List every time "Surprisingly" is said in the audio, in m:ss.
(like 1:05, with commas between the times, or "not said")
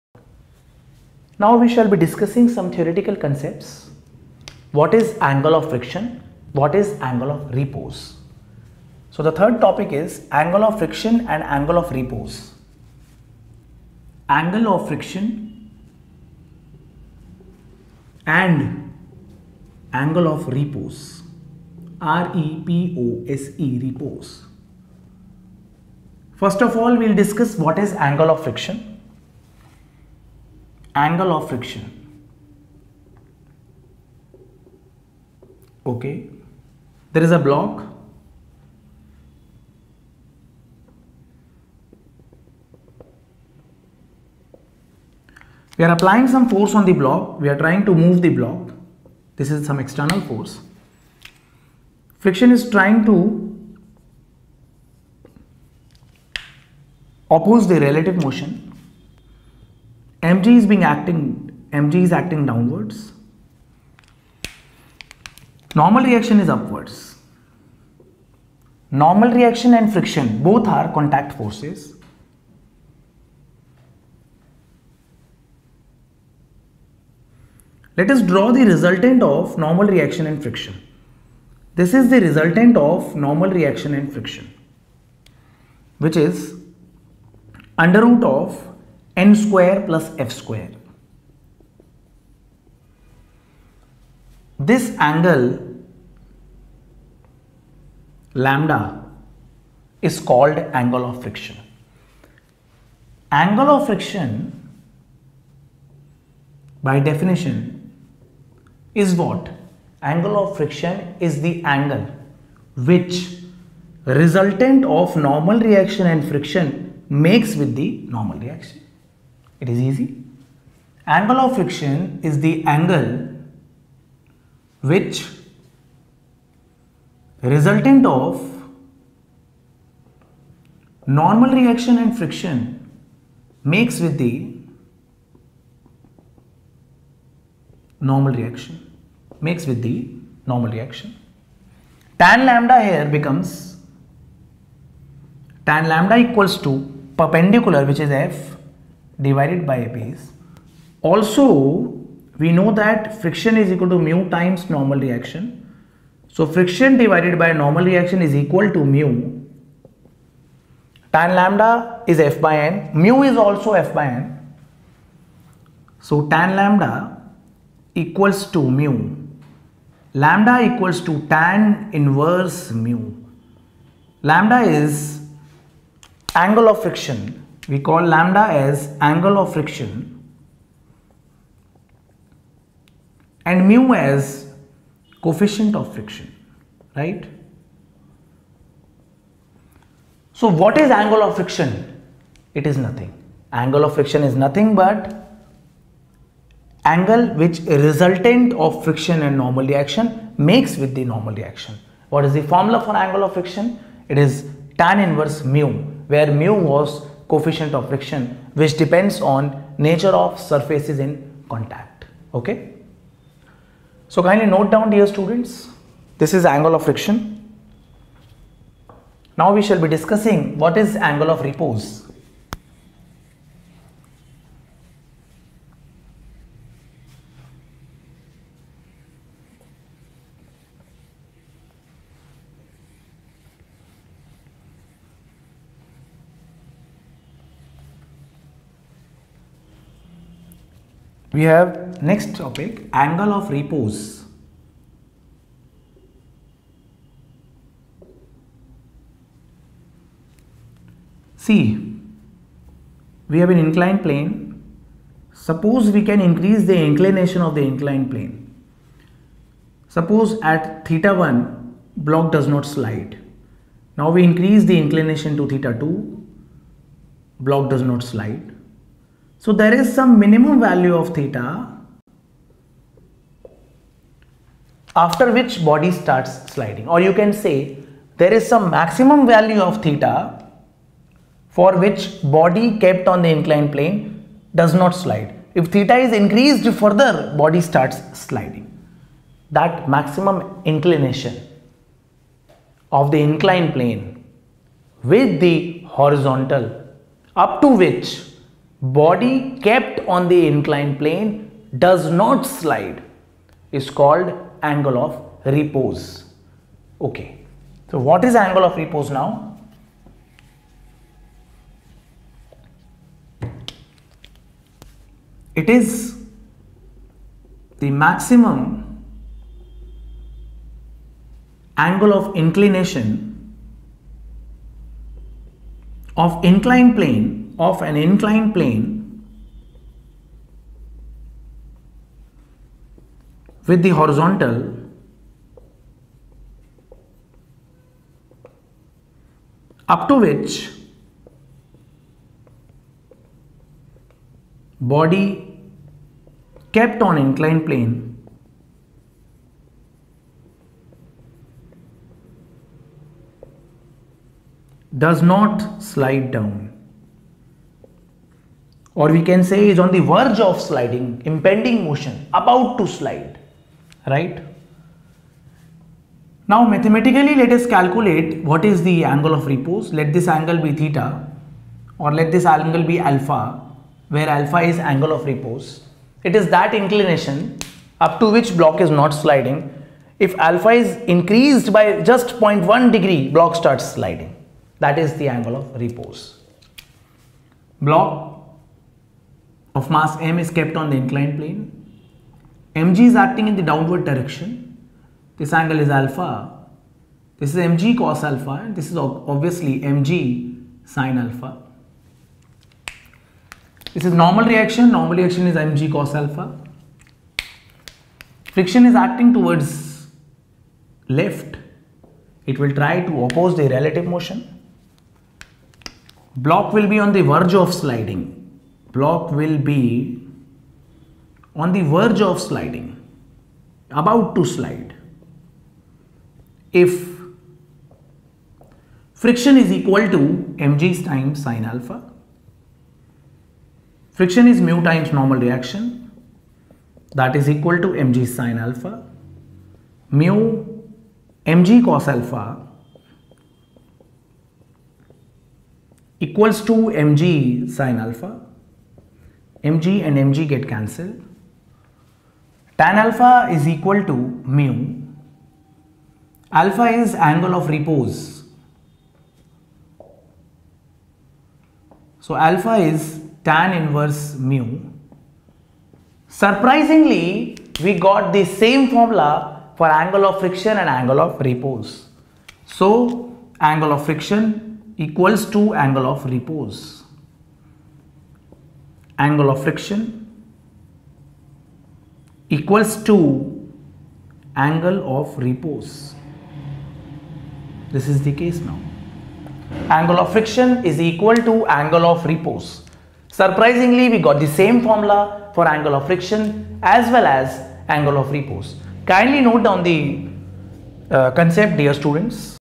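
7:46, 8:13.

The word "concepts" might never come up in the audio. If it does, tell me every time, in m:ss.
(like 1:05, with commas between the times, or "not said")
0:03, 8:21.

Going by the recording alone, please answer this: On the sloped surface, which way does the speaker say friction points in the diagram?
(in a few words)
towards left.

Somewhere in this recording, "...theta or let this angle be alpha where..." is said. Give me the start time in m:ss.
6:10.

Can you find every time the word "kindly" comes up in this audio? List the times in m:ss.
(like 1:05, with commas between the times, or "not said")
3:34, 8:19.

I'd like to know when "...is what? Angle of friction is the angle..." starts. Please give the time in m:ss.
1:49.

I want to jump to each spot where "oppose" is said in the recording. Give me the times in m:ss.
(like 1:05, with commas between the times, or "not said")
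0:57, 6:53.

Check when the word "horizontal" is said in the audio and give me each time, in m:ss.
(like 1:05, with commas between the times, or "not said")
4:55, 5:33.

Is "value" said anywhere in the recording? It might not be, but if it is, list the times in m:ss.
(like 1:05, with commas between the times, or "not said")
4:30, 4:39.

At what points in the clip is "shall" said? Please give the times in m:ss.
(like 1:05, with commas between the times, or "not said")
0:01, 3:39.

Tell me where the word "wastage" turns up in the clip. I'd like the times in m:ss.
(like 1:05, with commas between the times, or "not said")
not said.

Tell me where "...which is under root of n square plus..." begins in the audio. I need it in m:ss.
1:25.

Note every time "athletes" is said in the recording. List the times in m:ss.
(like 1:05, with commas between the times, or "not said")
not said.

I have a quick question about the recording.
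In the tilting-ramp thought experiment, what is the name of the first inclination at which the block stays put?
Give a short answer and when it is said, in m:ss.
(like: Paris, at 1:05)
theta 1, at 4:20.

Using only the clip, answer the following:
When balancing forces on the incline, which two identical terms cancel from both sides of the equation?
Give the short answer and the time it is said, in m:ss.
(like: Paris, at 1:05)
mg and mg, at 7:29.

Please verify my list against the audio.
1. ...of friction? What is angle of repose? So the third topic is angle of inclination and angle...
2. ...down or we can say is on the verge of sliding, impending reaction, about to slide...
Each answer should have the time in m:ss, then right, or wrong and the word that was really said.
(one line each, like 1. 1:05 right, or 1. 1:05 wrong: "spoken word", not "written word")
1. 0:05 wrong: "friction", not "inclination"
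2. 5:56 wrong: "motion", not "reaction".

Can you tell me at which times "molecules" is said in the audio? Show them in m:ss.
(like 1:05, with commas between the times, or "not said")
not said.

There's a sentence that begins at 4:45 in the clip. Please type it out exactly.
If theta is increased further body starts sliding.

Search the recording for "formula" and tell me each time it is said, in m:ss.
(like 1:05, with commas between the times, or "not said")
3:22, 7:48, 8:14.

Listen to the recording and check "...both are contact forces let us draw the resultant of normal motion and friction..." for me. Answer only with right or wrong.
wrong.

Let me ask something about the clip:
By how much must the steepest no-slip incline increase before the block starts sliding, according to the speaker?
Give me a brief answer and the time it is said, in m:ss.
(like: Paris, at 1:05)
0.1 degree, at 6:22.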